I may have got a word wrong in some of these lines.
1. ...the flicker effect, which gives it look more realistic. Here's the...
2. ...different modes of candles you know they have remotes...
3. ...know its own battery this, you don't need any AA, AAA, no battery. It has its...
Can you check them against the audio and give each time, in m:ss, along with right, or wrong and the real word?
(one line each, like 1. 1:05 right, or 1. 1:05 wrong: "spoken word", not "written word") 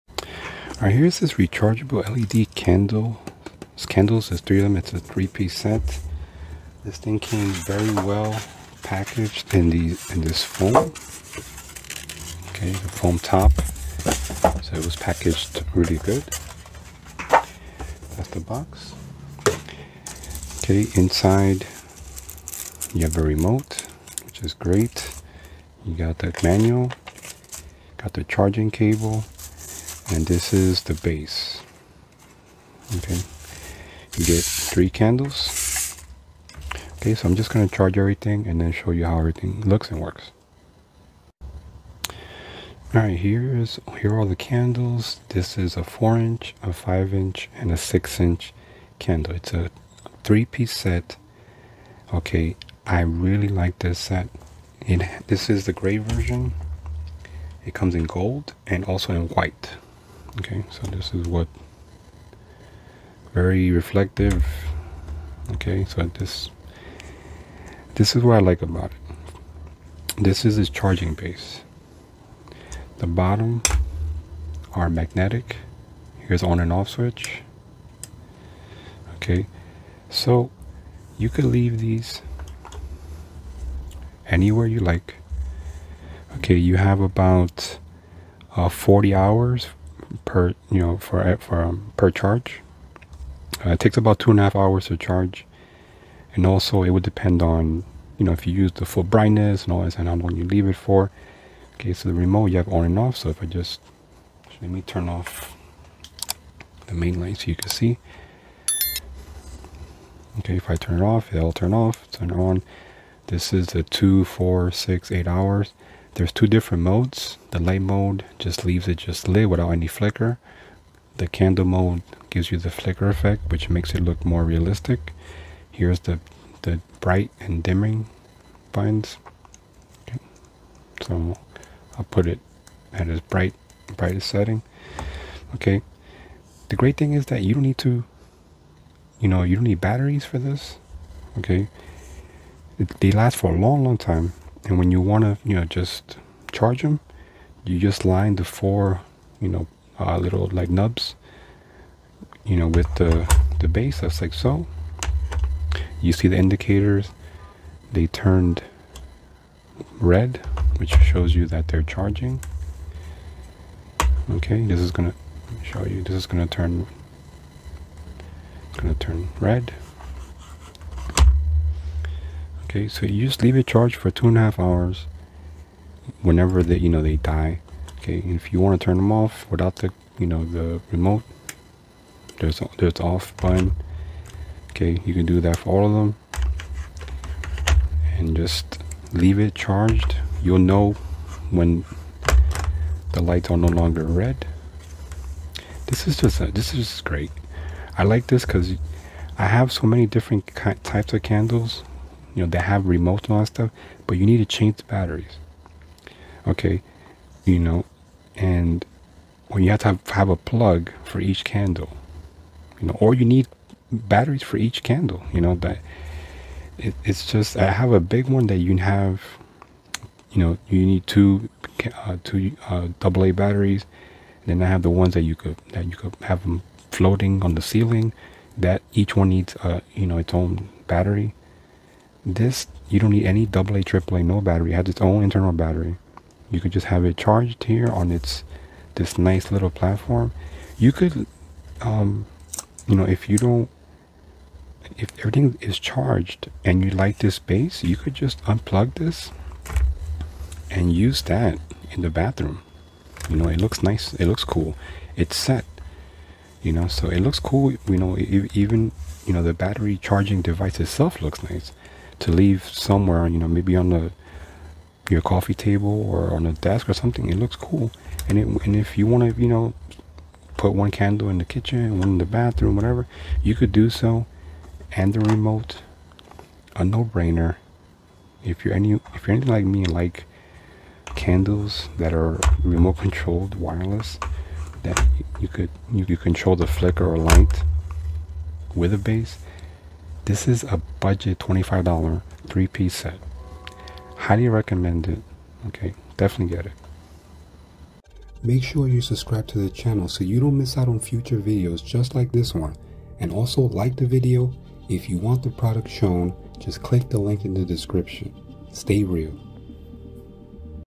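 1. 2:02 wrong: "makes", not "gives"
2. 3:20 wrong: "types", not "modes"
3. 3:50 right.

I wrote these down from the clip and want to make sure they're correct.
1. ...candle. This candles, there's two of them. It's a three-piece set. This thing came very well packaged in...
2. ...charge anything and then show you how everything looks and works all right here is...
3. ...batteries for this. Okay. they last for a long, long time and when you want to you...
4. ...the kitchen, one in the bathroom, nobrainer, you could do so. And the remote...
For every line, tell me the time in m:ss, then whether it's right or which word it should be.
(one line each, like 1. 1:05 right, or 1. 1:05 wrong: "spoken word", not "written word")
1. 0:02 wrong: "three", not "two"
2. 0:37 wrong: "everything", not "anything"
3. 2:19 right
4. 4:31 wrong: "whatever", not "nobrainer".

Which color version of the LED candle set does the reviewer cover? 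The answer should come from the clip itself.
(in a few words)
Gray.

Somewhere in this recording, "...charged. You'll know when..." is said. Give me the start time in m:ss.
3:09.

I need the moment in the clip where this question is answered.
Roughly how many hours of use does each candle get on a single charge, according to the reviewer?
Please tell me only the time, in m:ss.
1:28.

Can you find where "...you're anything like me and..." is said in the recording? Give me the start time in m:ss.
4:39.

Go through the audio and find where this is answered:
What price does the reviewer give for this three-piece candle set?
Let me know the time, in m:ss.
4:51.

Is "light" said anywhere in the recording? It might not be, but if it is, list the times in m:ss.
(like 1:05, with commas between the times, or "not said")
1:47, 1:57, 3:13, 4:47.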